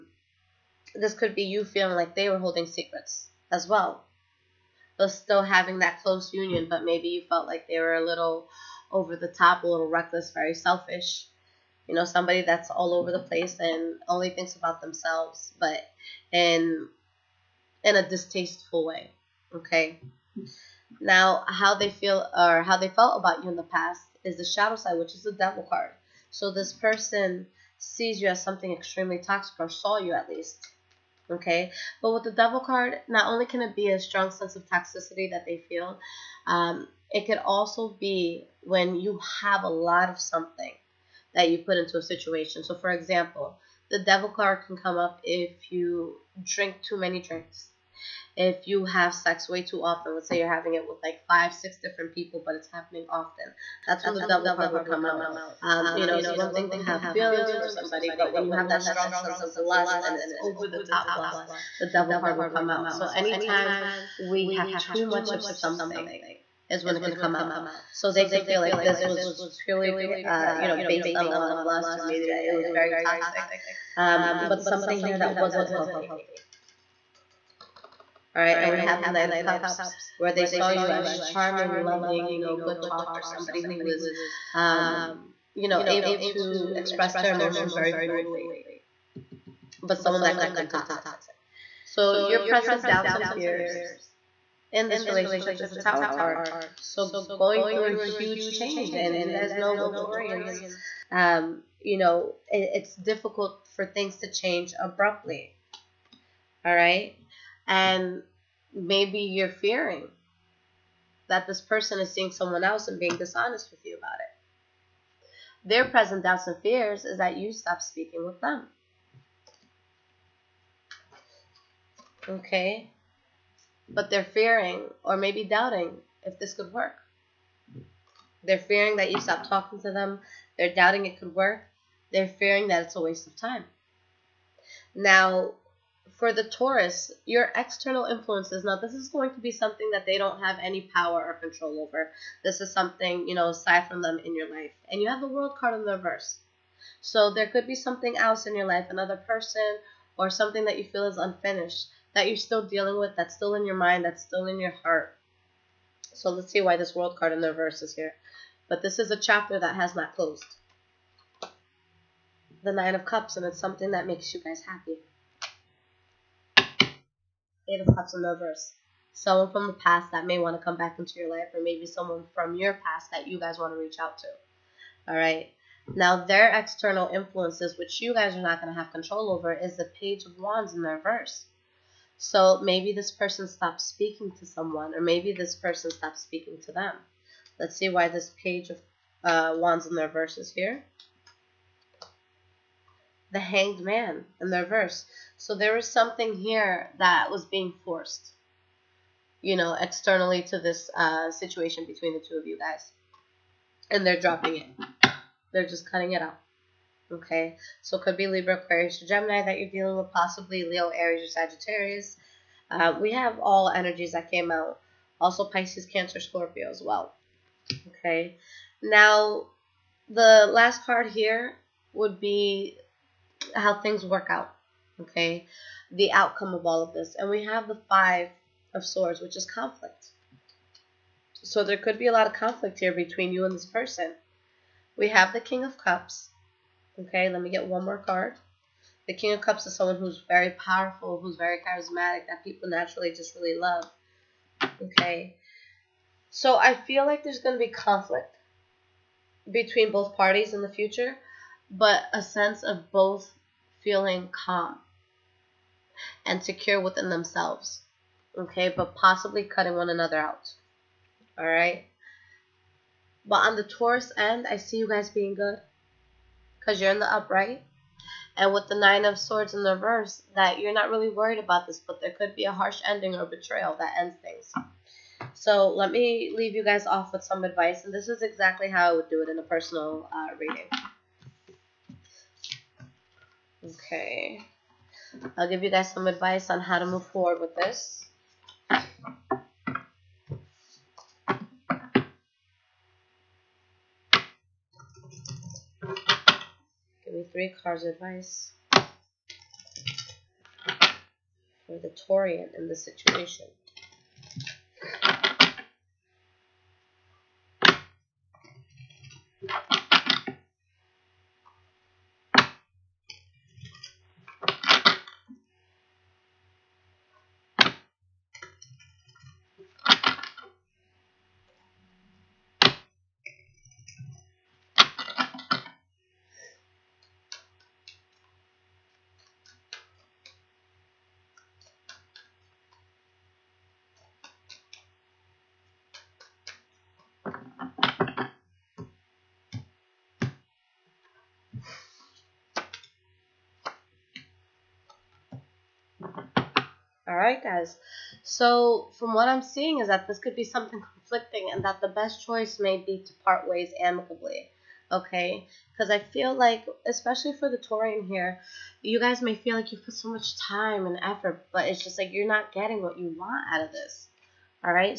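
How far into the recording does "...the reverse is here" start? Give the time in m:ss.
2:37.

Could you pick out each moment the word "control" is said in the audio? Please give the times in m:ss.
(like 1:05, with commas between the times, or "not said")
2:21, 2:58.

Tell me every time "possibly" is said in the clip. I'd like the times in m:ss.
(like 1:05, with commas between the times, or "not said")
3:30, 4:18.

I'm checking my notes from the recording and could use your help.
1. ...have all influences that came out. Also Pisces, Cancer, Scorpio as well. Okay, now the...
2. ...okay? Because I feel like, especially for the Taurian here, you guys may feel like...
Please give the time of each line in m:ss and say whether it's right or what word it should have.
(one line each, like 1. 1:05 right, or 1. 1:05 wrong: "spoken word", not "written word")
1. 3:33 wrong: "energies", not "influences"
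2. 5:54 right.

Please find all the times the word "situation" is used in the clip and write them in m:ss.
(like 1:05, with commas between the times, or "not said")
0:42, 3:21, 5:02.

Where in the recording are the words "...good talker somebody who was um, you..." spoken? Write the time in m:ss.
1:22.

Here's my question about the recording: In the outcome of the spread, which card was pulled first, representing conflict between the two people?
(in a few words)
Five of Swords.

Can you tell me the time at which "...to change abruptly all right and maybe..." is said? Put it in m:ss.
1:44.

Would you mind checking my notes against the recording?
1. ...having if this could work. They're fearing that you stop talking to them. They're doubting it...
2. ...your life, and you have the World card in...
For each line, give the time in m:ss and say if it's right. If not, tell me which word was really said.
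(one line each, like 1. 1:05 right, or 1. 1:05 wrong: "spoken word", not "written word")
1. 2:05 wrong: "doubting", not "having"
2. 2:24 right.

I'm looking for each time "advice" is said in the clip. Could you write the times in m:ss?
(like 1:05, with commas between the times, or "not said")
4:37, 4:46, 4:57.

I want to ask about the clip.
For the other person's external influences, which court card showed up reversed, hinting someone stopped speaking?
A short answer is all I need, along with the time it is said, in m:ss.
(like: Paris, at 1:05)
Page of Wands, at 2:59.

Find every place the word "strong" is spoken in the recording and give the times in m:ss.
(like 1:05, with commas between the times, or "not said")
0:33, 0:58.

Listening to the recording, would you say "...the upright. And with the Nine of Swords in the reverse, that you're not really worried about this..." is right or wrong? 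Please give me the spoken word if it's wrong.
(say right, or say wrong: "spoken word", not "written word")
right.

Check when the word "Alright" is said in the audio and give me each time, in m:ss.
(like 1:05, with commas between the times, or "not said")
4:21, 5:47.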